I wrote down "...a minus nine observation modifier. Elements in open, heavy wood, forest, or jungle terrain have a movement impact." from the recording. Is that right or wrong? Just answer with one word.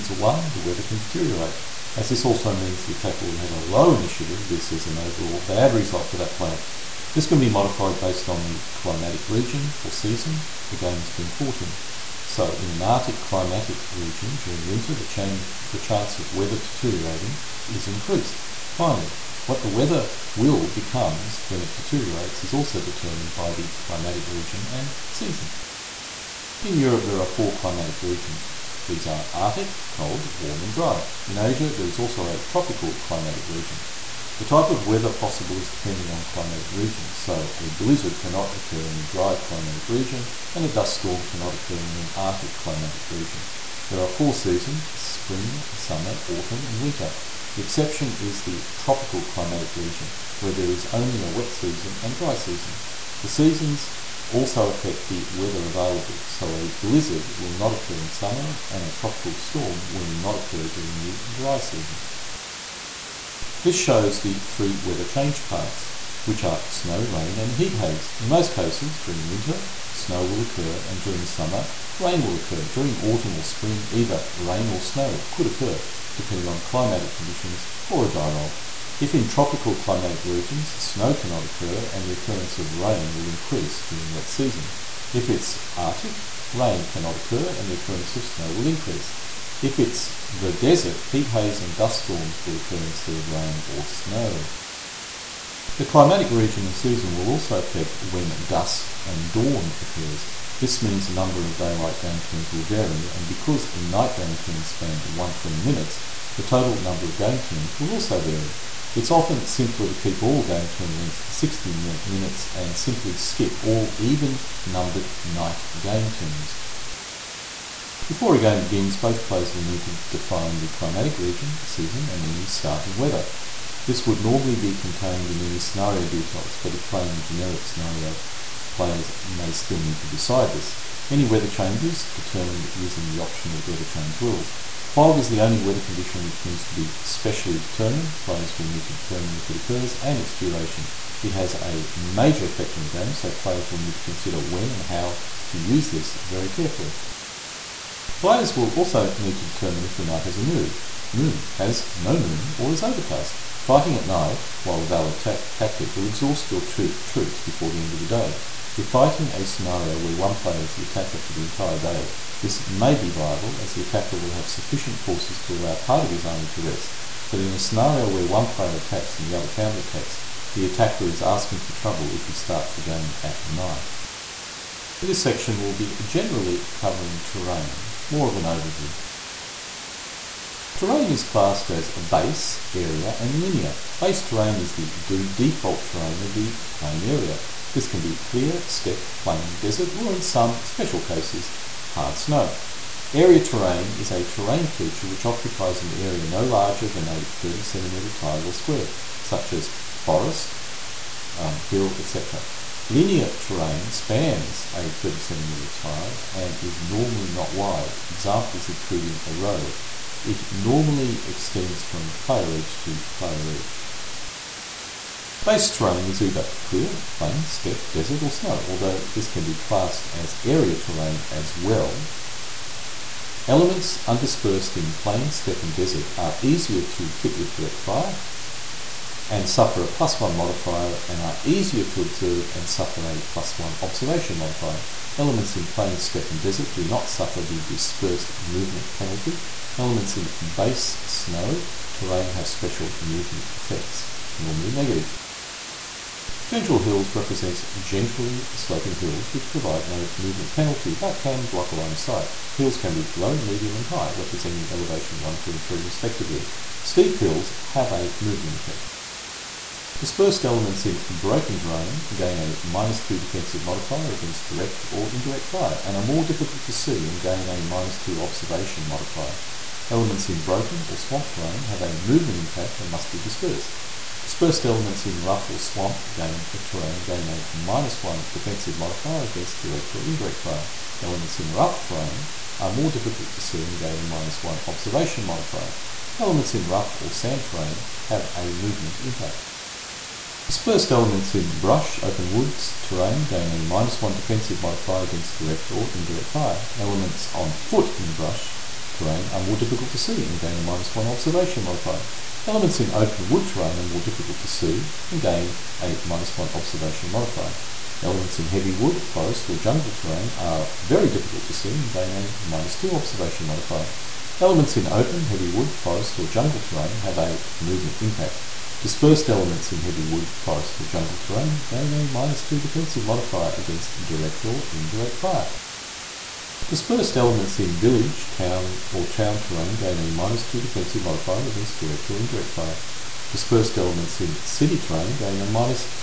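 wrong.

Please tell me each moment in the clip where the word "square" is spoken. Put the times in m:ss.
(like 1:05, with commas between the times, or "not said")
3:18.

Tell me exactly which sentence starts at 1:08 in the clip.
In most cases, during winter, snow will occur, and during summer, rain will occur.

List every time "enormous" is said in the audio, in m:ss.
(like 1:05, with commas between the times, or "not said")
not said.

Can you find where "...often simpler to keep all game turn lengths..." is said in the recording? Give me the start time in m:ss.
1:49.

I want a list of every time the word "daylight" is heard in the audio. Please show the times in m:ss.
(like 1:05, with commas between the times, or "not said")
1:41.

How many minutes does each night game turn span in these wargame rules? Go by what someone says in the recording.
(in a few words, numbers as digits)
120.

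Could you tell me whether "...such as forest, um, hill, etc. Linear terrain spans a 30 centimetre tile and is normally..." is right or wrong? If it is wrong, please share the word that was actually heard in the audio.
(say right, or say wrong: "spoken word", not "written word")
right.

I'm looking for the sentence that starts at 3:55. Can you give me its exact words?
Elements in plain, steppe and desert do not suffer the dispersed movement penalty.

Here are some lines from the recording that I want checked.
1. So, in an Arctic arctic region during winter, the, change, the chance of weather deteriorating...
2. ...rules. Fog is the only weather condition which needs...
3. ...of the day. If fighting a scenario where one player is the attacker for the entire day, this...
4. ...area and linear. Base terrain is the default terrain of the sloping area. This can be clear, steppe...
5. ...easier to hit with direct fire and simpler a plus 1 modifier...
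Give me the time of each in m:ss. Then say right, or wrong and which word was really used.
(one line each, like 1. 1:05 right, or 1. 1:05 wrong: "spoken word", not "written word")
1. 0:12 wrong: "climatic", not "arctic"
2. 2:14 right
3. 2:37 right
4. 3:02 wrong: "playing", not "sloping"
5. 3:46 wrong: "suffer", not "simpler".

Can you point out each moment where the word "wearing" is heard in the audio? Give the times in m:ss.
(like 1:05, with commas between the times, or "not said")
not said.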